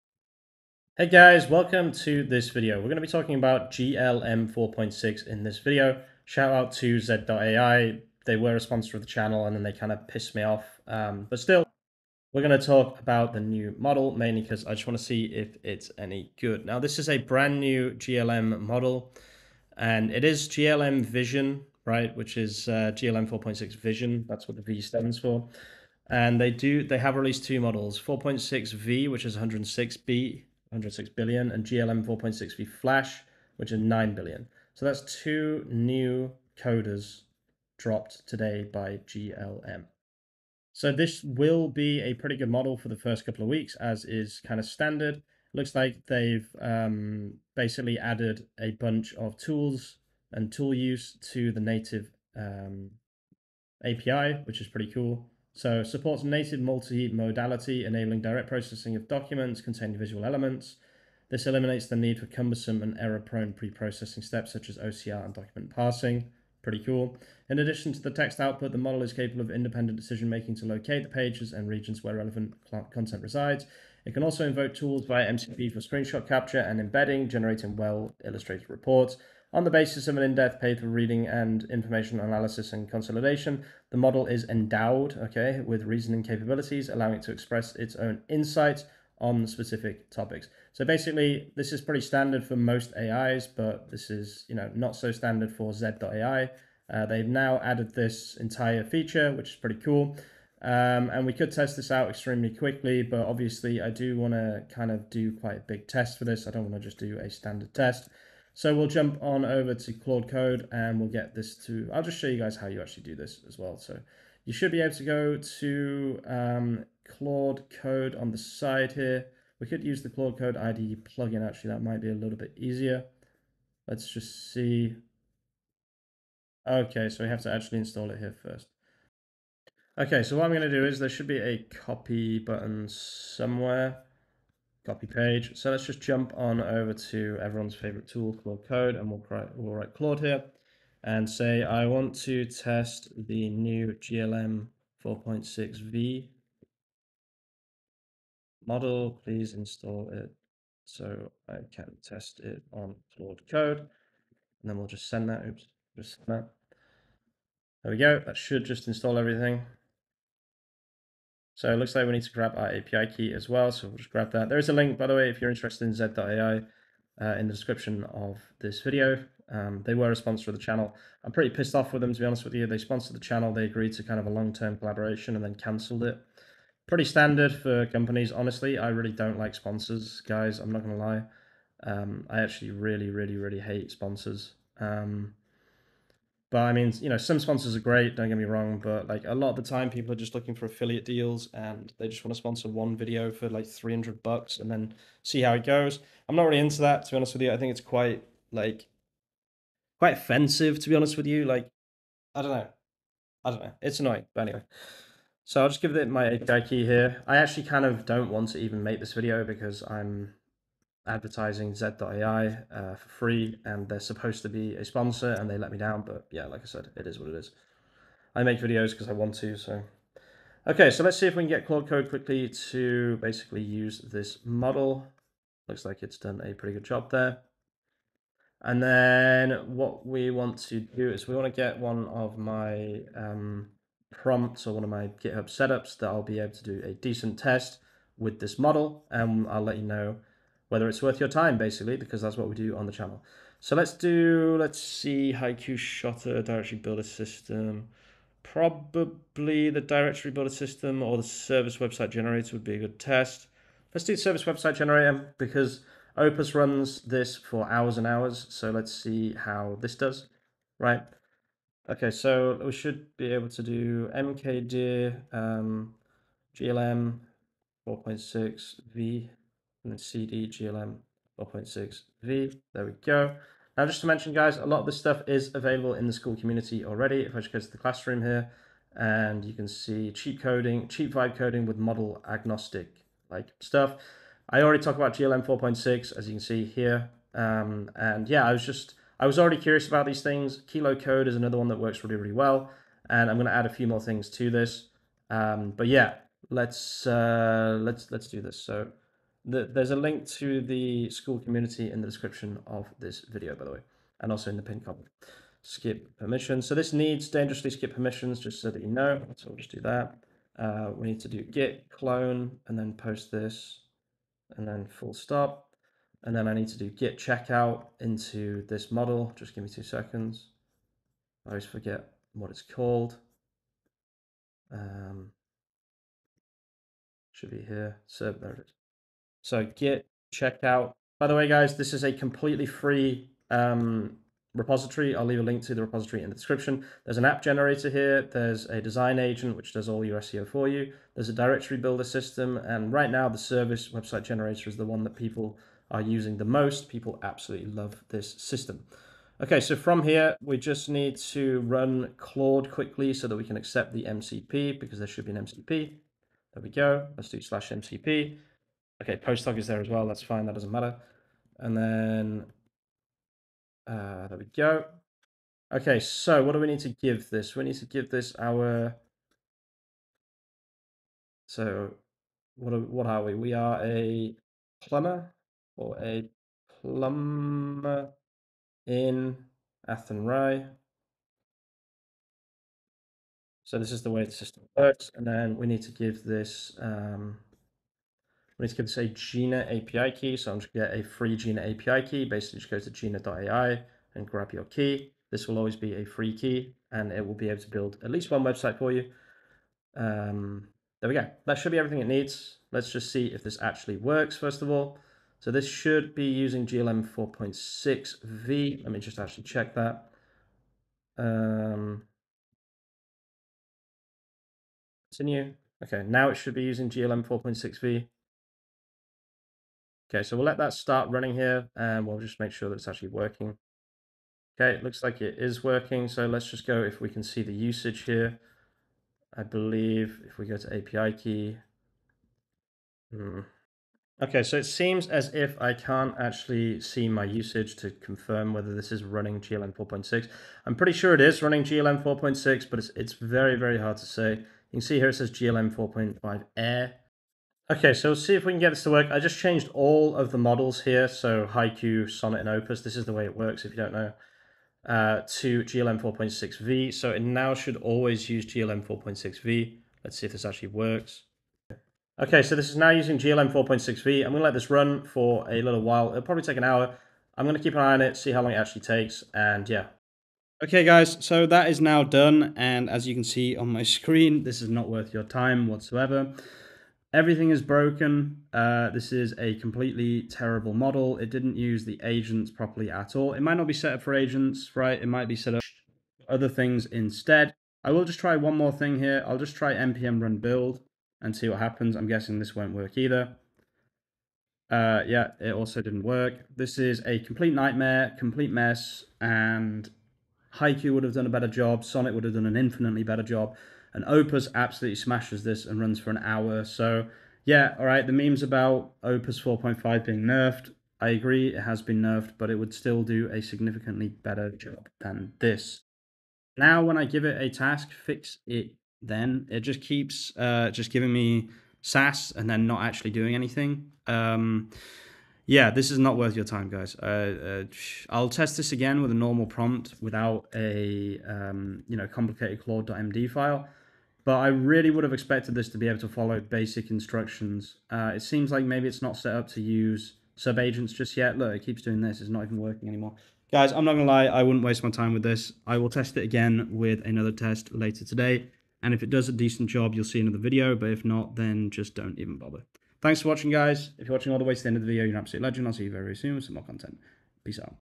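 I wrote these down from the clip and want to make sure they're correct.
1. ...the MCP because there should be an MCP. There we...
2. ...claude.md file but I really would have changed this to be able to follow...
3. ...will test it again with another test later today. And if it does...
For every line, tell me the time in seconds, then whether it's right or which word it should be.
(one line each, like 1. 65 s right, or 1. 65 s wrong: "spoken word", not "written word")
1. 353 s right
2. 532 s wrong: "expected", not "changed"
3. 545 s right.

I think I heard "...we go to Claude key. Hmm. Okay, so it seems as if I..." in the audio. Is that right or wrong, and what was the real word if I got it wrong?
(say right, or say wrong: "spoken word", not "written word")
wrong: "API", not "Claude".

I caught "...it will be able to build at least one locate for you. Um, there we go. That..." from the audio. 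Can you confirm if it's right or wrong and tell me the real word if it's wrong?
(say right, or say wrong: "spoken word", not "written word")
wrong: "website", not "locate".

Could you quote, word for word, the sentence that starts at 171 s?
I'm pretty pissed off with them, to be honest with you.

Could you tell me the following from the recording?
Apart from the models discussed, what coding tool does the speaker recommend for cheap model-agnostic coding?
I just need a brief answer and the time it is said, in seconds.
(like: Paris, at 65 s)
Kilo code, at 290 s.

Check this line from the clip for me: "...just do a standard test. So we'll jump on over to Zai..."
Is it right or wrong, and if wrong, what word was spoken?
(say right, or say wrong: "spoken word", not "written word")
wrong: "Claude", not "Zai".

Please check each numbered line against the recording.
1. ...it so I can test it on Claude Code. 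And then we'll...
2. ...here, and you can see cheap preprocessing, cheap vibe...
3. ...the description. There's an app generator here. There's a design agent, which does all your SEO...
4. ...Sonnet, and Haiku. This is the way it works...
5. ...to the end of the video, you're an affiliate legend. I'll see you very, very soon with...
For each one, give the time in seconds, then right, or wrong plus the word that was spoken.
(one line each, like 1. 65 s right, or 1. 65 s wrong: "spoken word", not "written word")
1. 150 s right
2. 278 s wrong: "coding", not "preprocessing"
3. 336 s right
4. 452 s wrong: "Opus", not "Haiku"
5. 554 s wrong: "absolute", not "affiliate".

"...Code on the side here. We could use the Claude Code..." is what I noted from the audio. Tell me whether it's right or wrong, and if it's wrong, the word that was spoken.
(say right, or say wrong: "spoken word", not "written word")
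right.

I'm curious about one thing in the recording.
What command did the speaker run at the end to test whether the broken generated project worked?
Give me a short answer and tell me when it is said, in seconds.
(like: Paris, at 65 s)
npm run build, at 489 s.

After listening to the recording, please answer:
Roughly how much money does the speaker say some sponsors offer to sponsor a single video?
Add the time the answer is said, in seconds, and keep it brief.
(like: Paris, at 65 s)
300 bucks, at 193 s.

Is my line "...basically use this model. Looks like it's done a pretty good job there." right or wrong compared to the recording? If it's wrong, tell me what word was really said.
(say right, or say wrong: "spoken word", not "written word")
right.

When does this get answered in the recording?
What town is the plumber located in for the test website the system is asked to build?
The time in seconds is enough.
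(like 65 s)
379 s.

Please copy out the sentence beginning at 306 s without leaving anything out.
So this needs dangerously skip permissions, just so that you know.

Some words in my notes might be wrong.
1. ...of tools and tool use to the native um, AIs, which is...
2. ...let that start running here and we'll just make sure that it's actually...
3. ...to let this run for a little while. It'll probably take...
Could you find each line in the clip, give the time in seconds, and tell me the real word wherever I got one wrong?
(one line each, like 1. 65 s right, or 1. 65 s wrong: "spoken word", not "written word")
1. 49 s wrong: "API", not "AIs"
2. 420 s right
3. 464 s right.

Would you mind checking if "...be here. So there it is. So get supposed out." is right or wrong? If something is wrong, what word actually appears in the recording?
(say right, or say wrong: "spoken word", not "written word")
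wrong: "checked", not "supposed".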